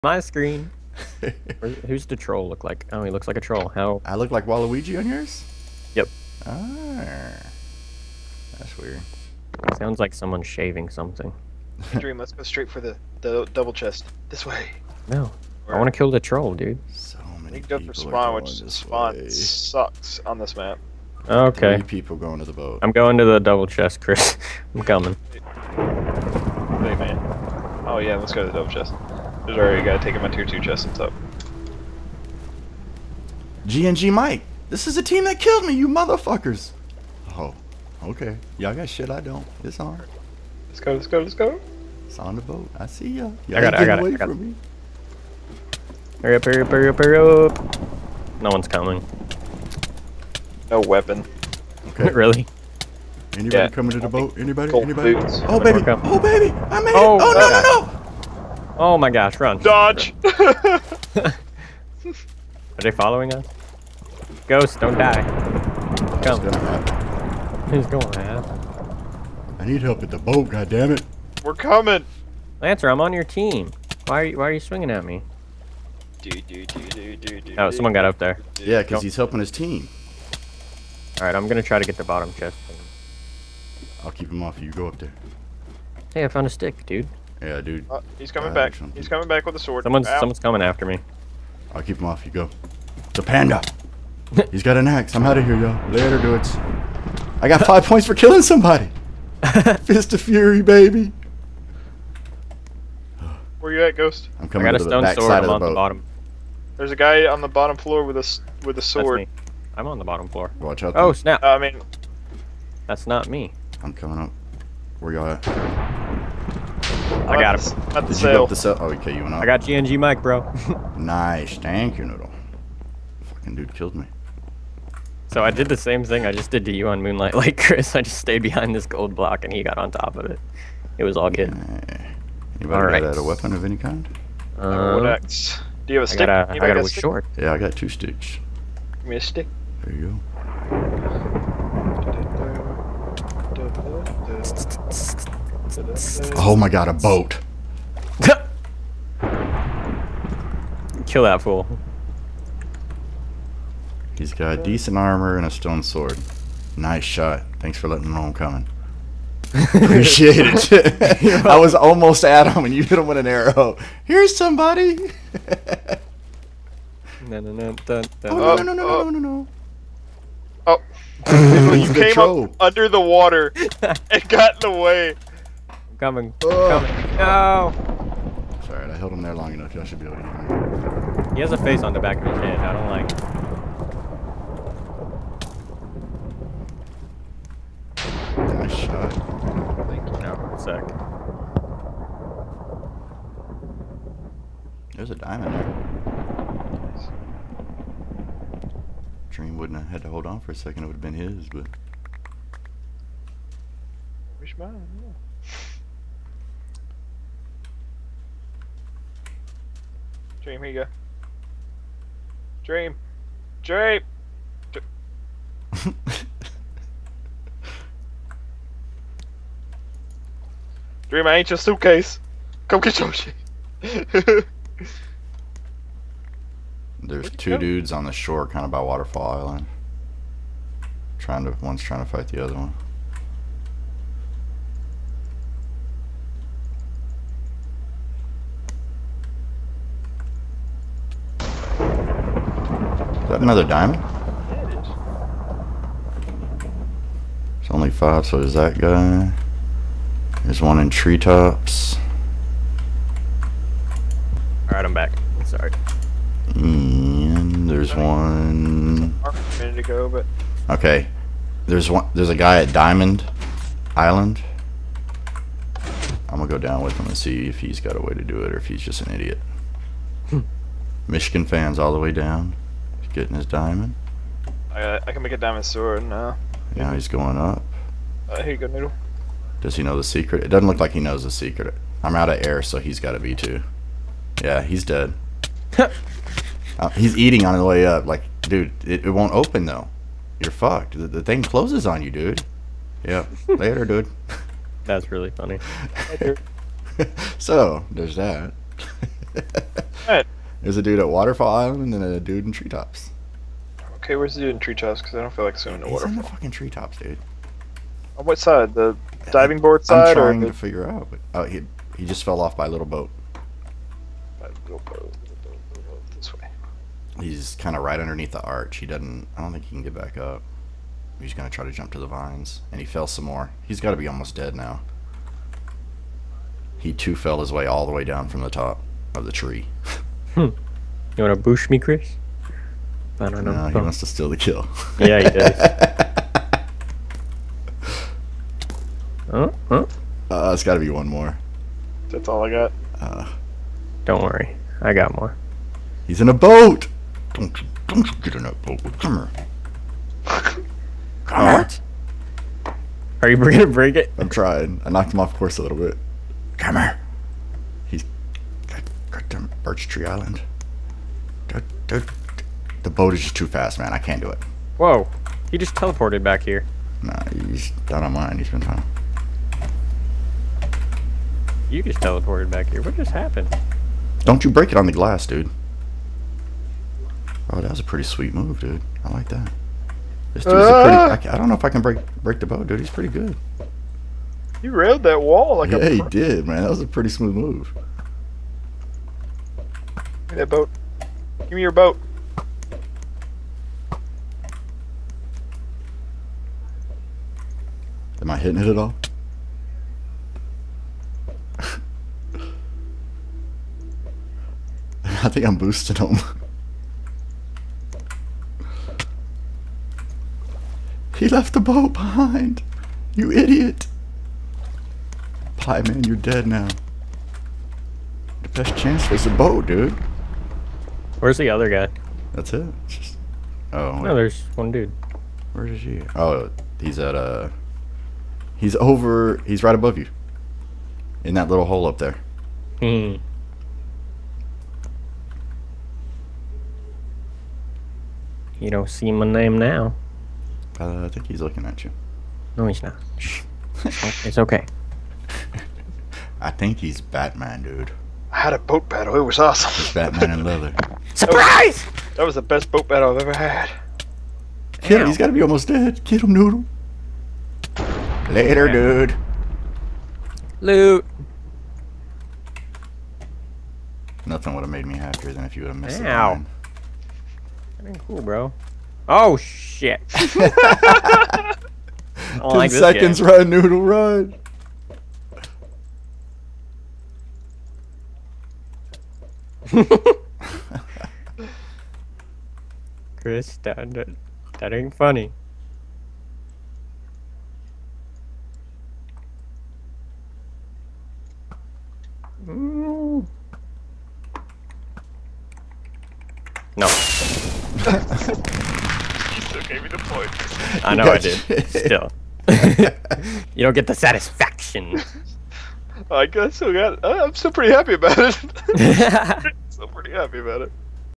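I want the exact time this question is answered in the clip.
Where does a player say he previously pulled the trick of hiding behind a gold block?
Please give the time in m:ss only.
2:07.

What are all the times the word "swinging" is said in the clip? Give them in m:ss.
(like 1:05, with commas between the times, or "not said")
1:14.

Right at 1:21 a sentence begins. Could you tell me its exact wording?
Alright, I'm gonna try to get the bottom chest.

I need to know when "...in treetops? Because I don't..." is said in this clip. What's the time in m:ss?
5:04.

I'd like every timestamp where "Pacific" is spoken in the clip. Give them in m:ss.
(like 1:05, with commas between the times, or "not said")
not said.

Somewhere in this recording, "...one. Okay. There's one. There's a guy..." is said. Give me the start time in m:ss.
4:17.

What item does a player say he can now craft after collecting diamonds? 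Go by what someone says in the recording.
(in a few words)
diamond sword.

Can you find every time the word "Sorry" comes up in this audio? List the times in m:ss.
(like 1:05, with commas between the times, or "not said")
4:15.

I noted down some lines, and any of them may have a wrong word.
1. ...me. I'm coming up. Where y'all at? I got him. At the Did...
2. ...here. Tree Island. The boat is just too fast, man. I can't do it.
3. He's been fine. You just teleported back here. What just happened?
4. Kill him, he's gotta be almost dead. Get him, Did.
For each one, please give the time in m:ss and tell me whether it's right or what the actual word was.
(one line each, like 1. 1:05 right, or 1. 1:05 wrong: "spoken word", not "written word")
1. 1:53 right
2. 5:56 right
3. 6:08 right
4. 7:34 wrong: "Noodle", not "Did".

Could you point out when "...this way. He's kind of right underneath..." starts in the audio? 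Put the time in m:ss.
5:16.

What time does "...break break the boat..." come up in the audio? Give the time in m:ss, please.
6:21.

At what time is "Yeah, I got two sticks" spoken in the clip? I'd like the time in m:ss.
2:17.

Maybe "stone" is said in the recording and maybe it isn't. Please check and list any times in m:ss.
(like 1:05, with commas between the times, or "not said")
1:44, 2:35.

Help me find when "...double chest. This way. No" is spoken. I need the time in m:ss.
0:13.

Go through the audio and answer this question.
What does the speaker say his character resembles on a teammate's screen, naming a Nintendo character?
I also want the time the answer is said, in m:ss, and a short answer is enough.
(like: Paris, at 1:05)
Waluigi, at 0:04.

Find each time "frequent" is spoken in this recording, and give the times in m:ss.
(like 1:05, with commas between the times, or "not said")
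not said.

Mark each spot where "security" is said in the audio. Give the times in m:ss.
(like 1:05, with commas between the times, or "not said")
not said.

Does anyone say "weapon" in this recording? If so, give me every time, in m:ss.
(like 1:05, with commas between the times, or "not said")
0:50, 2:13.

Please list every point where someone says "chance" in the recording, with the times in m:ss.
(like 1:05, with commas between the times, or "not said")
6:58.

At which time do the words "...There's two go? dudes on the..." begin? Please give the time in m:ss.
3:47.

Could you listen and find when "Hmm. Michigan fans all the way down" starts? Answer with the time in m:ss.
4:30.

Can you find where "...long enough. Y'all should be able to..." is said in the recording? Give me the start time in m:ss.
2:59.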